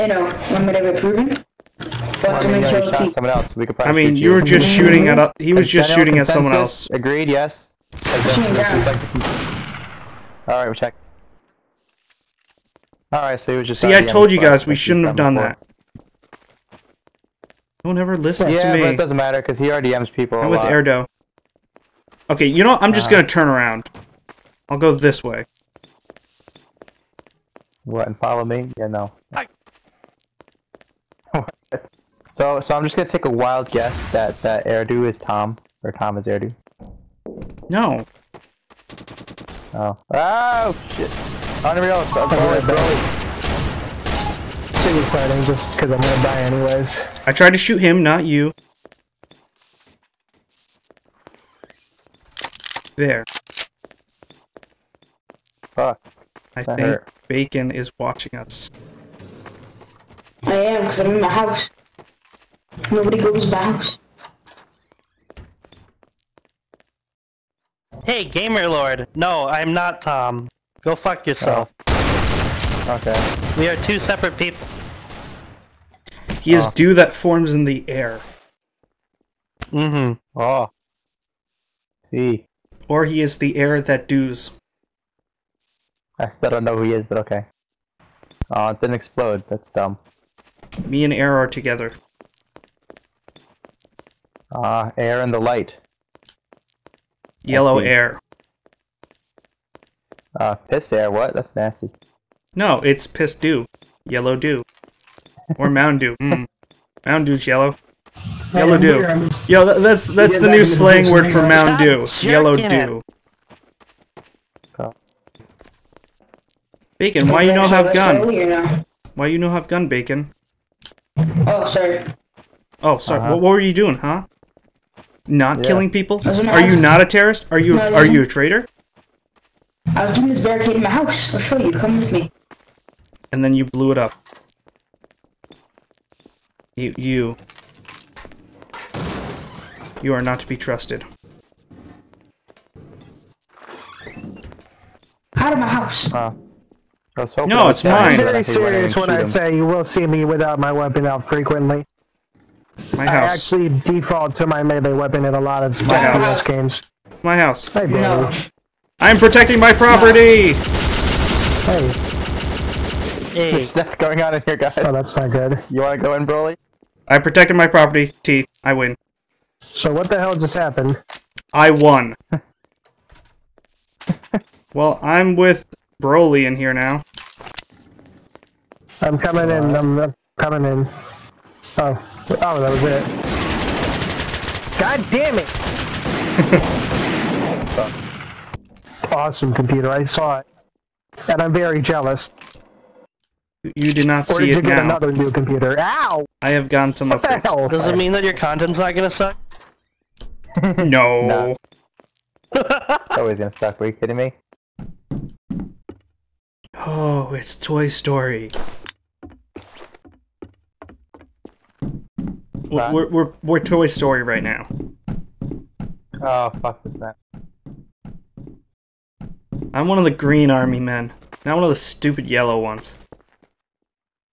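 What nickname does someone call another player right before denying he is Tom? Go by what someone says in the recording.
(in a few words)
Gamer Lord.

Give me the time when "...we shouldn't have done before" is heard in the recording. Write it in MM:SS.
00:14.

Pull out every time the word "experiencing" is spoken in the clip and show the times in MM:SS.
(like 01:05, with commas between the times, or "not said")
not said.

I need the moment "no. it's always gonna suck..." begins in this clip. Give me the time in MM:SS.
03:21.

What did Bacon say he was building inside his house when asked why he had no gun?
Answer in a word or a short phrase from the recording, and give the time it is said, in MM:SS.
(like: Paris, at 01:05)
barricade, at 02:10.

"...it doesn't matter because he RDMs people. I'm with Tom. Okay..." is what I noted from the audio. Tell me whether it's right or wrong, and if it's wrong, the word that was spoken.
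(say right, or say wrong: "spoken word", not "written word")
wrong: "Erdo", not "Tom".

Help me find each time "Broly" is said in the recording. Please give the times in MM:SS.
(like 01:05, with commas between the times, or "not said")
02:46, 02:56.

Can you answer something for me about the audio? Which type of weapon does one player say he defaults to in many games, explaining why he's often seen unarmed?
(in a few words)
melee weapon.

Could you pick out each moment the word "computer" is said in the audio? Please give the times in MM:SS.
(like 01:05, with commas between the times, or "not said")
03:09, 03:15.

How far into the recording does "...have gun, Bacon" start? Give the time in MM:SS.
01:59.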